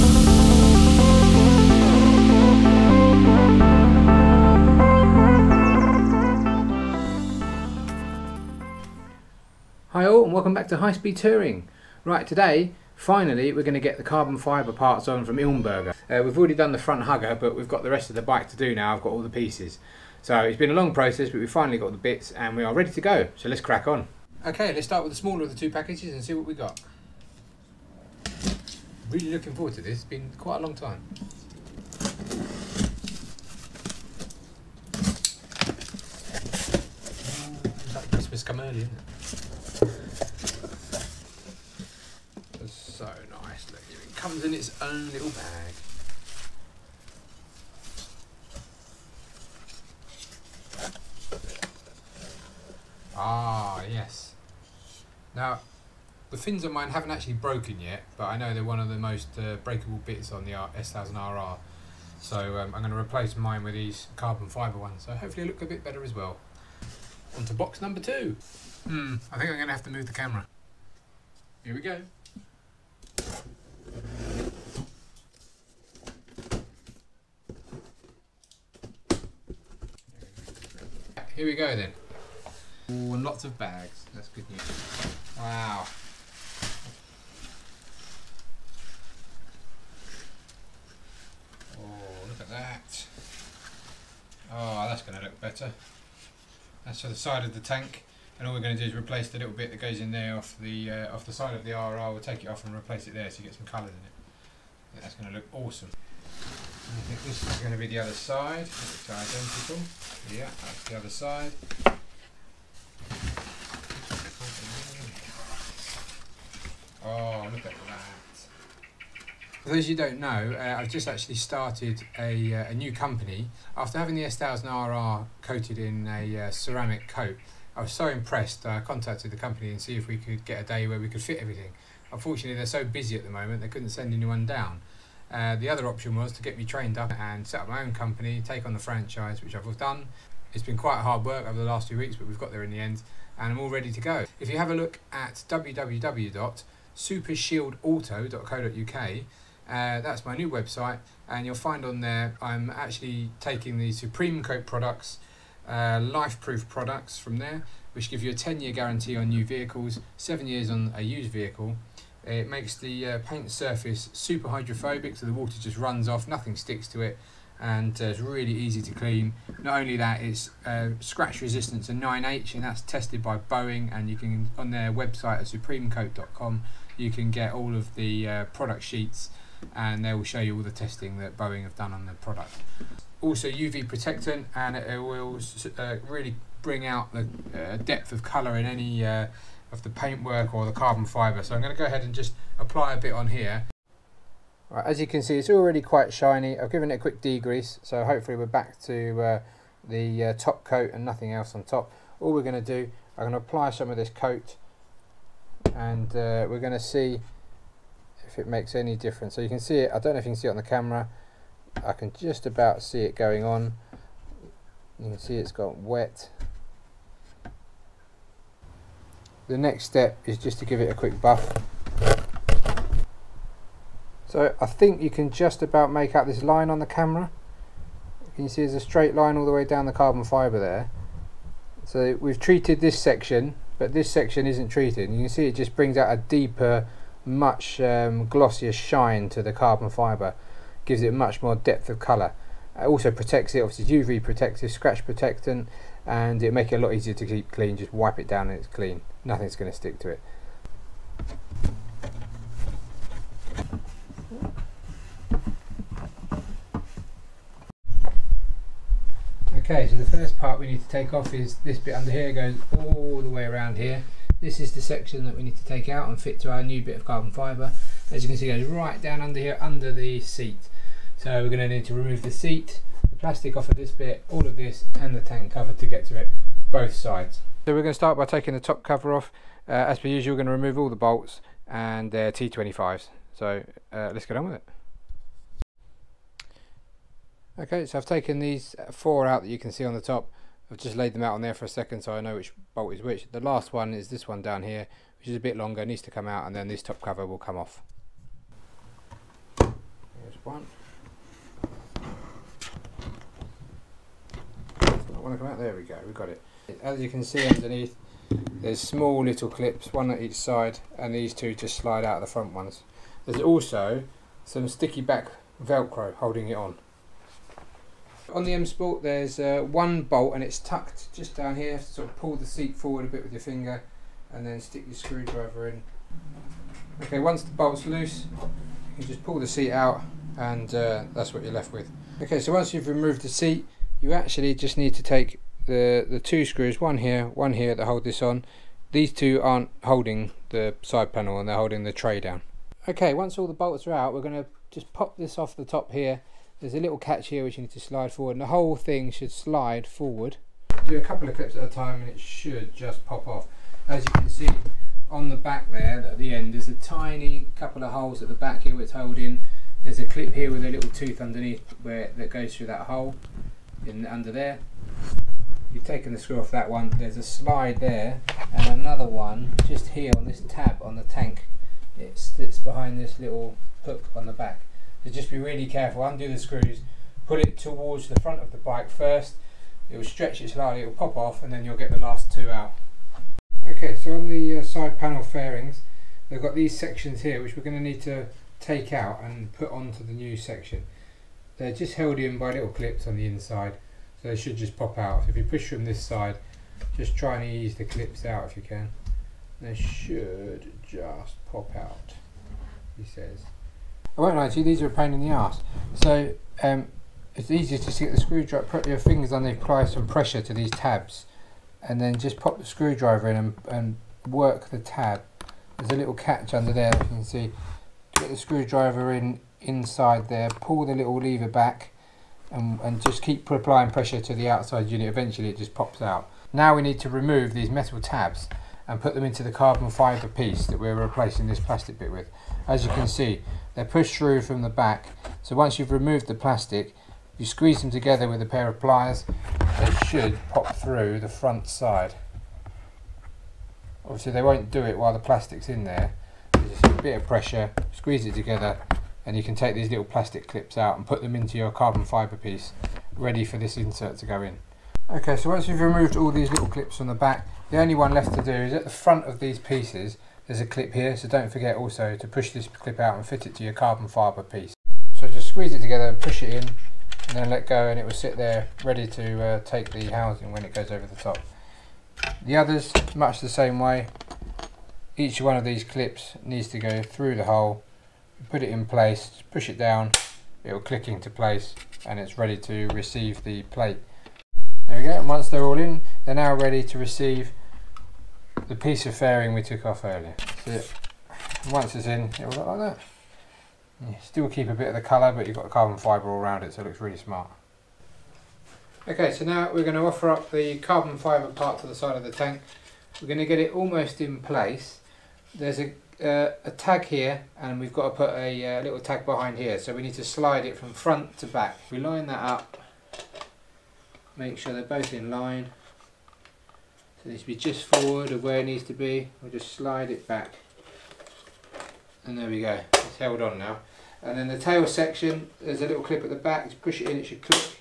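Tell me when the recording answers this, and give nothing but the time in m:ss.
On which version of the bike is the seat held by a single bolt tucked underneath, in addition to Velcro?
5:18.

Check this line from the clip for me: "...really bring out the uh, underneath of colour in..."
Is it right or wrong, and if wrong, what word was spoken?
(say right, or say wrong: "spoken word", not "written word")
wrong: "depth", not "underneath".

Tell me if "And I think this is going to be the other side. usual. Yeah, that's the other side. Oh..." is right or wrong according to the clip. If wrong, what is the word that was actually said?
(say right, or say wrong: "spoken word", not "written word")
wrong: "identical", not "usual".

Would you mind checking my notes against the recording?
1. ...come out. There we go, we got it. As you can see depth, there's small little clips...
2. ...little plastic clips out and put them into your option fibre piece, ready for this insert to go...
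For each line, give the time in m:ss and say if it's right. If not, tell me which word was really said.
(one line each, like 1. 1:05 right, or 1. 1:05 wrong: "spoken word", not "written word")
1. 5:05 wrong: "underneath", not "depth"
2. 7:29 wrong: "carbon", not "option".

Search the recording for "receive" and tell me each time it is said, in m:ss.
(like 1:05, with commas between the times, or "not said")
8:02, 8:06.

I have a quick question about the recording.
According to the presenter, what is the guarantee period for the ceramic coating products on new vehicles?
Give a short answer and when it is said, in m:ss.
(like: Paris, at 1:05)
10 years, at 2:38.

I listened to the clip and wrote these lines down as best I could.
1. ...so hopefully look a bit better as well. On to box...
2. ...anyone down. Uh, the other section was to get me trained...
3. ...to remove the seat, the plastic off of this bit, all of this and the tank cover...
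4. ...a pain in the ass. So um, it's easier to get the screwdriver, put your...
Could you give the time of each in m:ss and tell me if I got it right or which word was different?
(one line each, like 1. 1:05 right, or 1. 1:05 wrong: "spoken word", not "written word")
1. 1:05 right
2. 2:14 wrong: "option", not "section"
3. 4:31 right
4. 6:44 right.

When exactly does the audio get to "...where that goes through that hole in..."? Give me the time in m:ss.
6:01.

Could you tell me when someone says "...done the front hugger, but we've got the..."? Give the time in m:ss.
0:16.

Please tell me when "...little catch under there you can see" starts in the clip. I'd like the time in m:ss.
6:55.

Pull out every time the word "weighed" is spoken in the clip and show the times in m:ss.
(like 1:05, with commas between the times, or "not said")
not said.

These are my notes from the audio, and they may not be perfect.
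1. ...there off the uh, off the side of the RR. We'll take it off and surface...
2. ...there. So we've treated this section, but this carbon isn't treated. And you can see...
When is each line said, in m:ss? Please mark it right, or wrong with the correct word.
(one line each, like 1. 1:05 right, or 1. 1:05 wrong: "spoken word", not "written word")
1. 1:40 wrong: "replace", not "surface"
2. 3:50 wrong: "section", not "carbon".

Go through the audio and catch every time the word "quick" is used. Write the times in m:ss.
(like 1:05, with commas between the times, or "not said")
3:16, 3:40.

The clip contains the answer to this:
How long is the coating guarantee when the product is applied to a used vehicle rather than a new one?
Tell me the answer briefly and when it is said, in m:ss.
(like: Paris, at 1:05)
7 years, at 2:40.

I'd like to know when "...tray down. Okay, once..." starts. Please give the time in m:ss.
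5:41.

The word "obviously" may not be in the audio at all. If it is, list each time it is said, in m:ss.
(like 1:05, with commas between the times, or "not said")
4:03, 7:24.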